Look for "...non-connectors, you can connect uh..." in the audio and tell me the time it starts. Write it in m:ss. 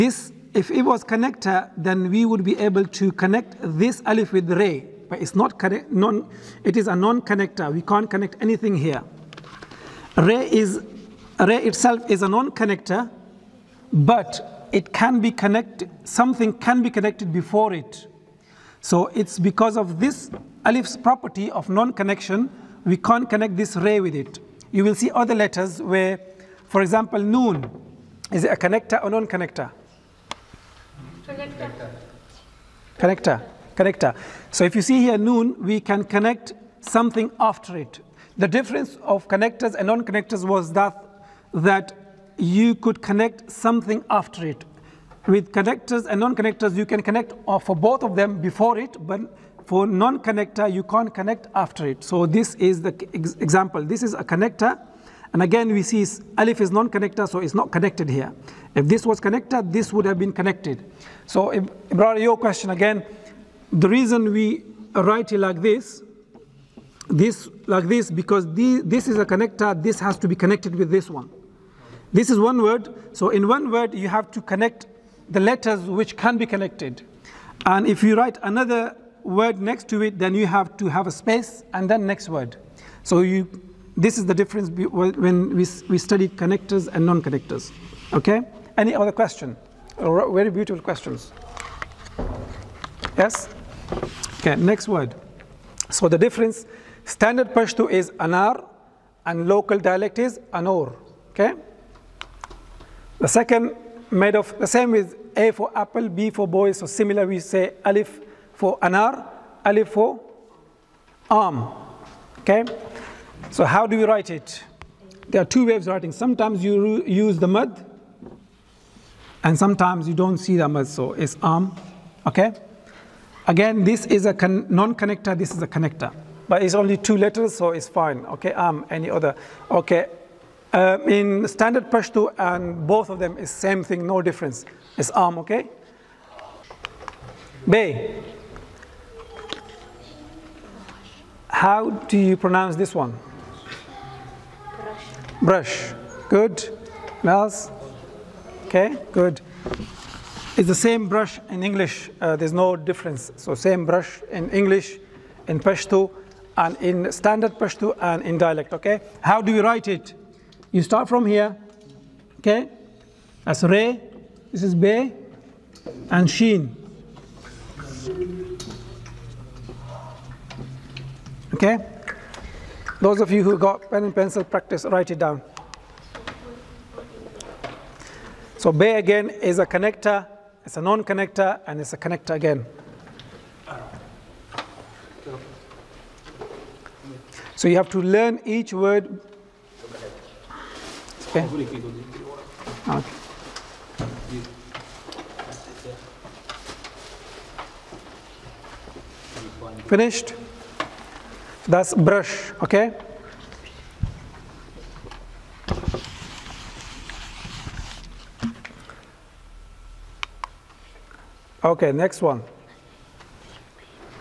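0:46.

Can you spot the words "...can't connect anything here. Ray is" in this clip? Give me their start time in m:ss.
0:07.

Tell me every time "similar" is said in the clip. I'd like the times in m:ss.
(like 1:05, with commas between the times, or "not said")
1:46.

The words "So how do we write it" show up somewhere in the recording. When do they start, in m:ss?
1:53.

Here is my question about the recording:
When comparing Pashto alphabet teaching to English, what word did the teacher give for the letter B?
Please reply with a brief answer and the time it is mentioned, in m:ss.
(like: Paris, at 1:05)
boy, at 1:46.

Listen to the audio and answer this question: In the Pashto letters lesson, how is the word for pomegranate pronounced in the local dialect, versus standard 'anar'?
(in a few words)
anor.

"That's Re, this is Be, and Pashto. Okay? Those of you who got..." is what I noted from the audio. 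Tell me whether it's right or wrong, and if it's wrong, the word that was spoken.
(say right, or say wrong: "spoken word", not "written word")
wrong: "Sheen", not "Pashto".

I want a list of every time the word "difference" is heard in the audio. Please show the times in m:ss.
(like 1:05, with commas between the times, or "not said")
0:38, 1:24, 1:36, 2:14, 2:32.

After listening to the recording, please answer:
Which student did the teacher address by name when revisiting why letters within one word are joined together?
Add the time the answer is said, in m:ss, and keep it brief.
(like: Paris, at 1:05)
Ibrahim, at 1:01.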